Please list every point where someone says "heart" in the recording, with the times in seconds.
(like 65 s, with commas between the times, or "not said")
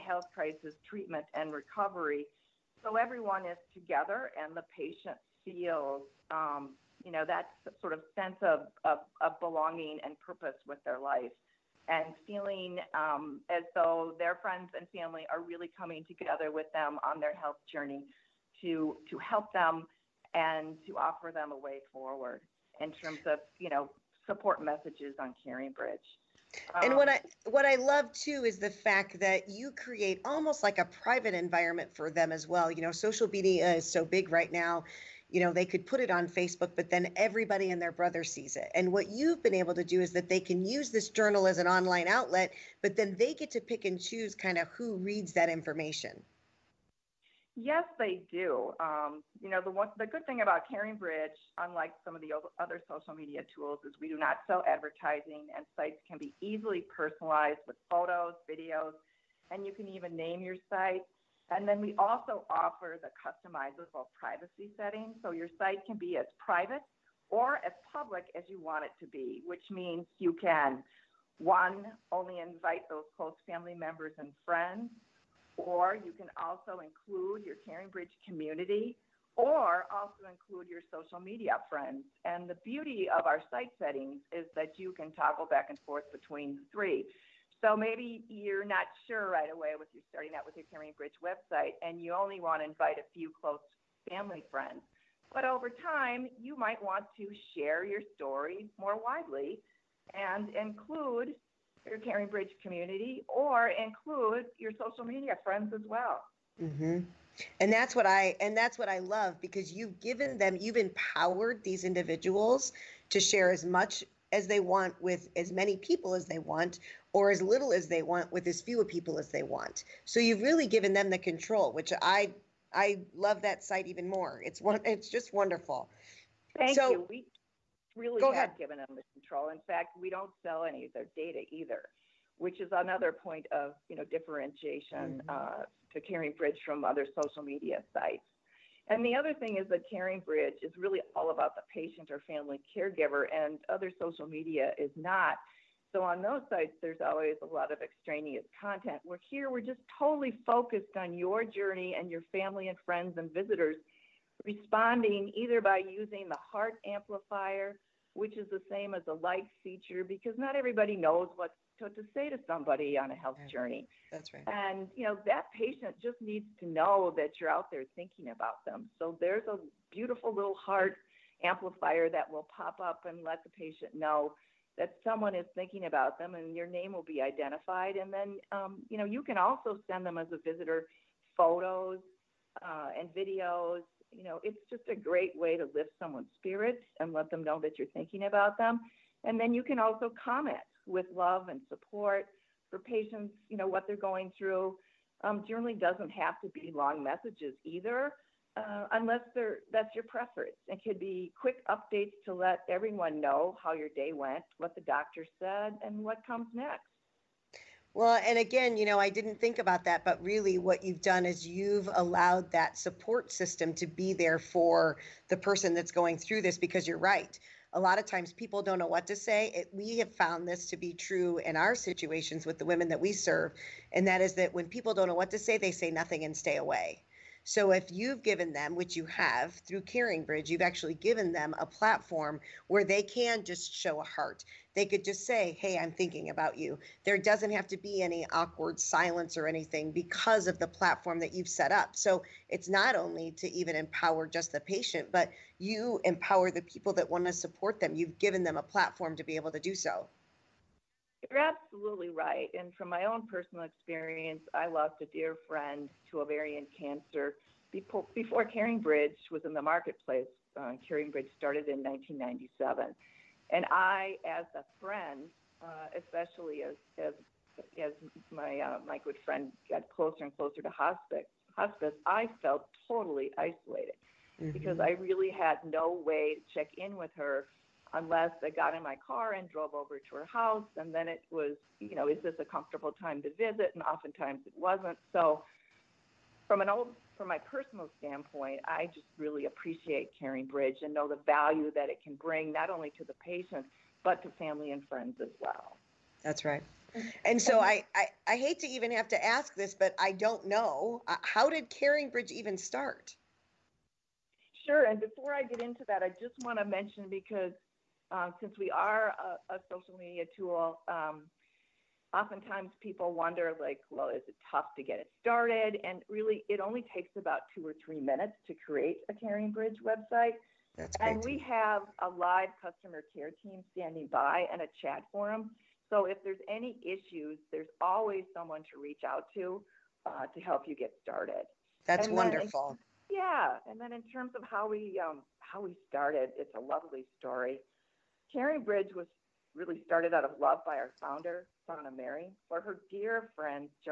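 156 s, 170 s, 234 s.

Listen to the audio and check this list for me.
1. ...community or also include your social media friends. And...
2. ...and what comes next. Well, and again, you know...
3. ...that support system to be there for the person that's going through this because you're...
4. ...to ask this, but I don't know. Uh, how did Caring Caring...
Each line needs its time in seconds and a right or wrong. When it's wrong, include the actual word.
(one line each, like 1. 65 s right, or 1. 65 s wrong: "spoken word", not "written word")
1. 78 s right
2. 205 s right
3. 212 s right
4. 299 s wrong: "Bridge", not "Caring".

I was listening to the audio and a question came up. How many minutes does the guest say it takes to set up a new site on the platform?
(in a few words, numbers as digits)
2 or 3 minutes.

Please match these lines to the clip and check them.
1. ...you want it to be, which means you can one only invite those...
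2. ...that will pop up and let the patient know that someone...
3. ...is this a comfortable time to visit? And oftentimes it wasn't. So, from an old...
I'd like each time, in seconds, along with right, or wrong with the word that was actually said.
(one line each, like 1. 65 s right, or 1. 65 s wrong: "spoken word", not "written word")
1. 68 s right
2. 172 s right
3. 282 s right.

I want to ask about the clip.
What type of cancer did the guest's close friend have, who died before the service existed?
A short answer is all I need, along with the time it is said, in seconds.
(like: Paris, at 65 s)
ovarian cancer, at 256 s.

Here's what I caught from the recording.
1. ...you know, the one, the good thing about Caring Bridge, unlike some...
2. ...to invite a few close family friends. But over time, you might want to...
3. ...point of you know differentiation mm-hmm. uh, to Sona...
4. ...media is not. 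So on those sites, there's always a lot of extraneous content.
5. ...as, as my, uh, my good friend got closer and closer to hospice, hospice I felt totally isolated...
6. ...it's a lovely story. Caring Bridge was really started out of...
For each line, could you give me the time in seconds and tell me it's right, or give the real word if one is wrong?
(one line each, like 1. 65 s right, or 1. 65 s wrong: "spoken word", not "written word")
1. 49 s right
2. 92 s right
3. 133 s wrong: "Caring", not "Sona"
4. 144 s right
5. 267 s right
6. 336 s right.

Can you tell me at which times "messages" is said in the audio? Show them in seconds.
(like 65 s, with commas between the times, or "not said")
24 s, 197 s.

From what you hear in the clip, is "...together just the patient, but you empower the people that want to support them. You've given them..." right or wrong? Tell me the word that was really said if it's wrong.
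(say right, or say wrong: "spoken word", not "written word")
wrong: "empower", not "together".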